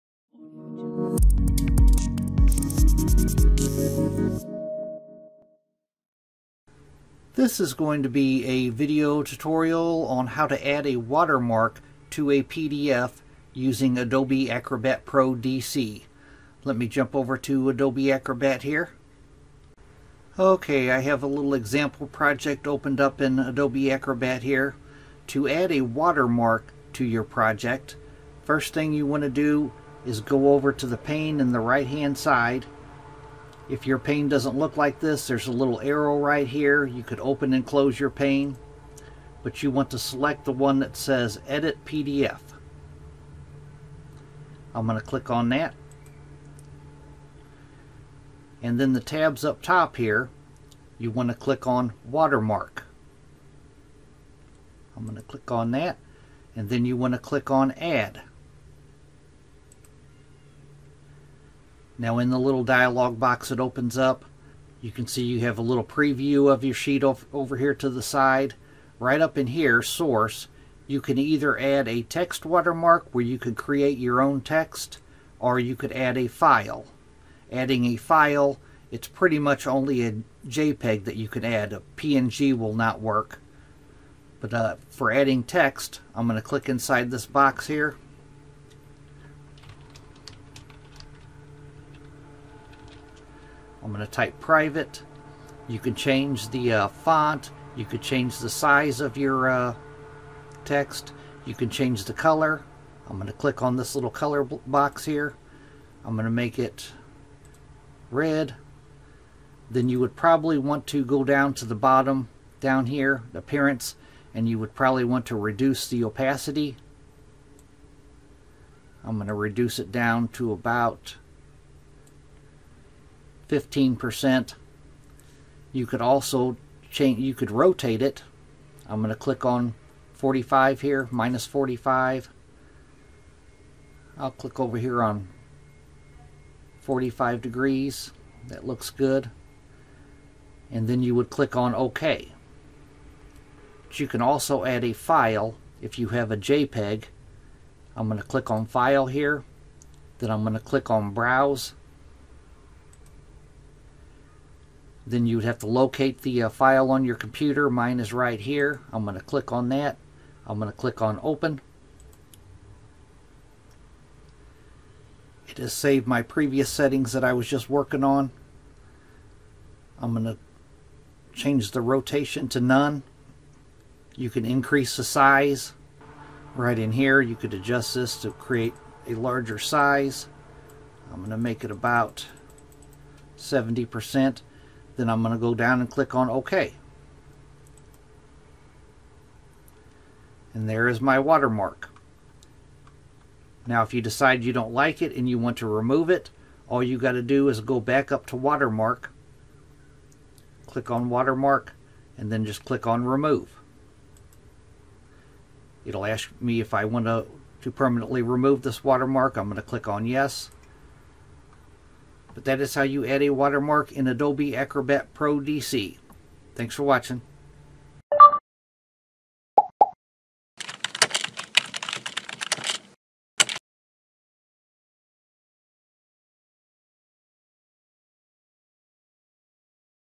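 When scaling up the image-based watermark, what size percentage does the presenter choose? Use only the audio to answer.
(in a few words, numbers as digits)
70%.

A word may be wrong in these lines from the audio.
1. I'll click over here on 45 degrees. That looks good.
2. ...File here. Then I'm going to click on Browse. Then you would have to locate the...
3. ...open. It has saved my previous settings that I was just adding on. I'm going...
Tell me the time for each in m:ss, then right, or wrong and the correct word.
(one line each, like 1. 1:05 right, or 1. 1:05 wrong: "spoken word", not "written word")
1. 2:14 right
2. 2:28 right
3. 2:41 wrong: "working", not "adding".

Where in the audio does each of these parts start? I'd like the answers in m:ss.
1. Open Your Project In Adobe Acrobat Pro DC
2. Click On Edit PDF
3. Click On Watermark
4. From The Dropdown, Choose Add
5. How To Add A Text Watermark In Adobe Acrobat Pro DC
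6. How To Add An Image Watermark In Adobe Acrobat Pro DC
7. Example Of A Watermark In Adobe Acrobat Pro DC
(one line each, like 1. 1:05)
1. 0:18
2. 0:35
3. 0:50
4. 1:00
5. 1:10
6. 2:20
7. 3:05.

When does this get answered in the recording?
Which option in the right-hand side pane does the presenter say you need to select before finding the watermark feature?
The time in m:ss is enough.
0:41.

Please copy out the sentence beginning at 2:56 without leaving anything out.
Right in here, you could adjust this to create a larger size.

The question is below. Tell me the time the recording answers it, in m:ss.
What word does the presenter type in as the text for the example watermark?
1:34.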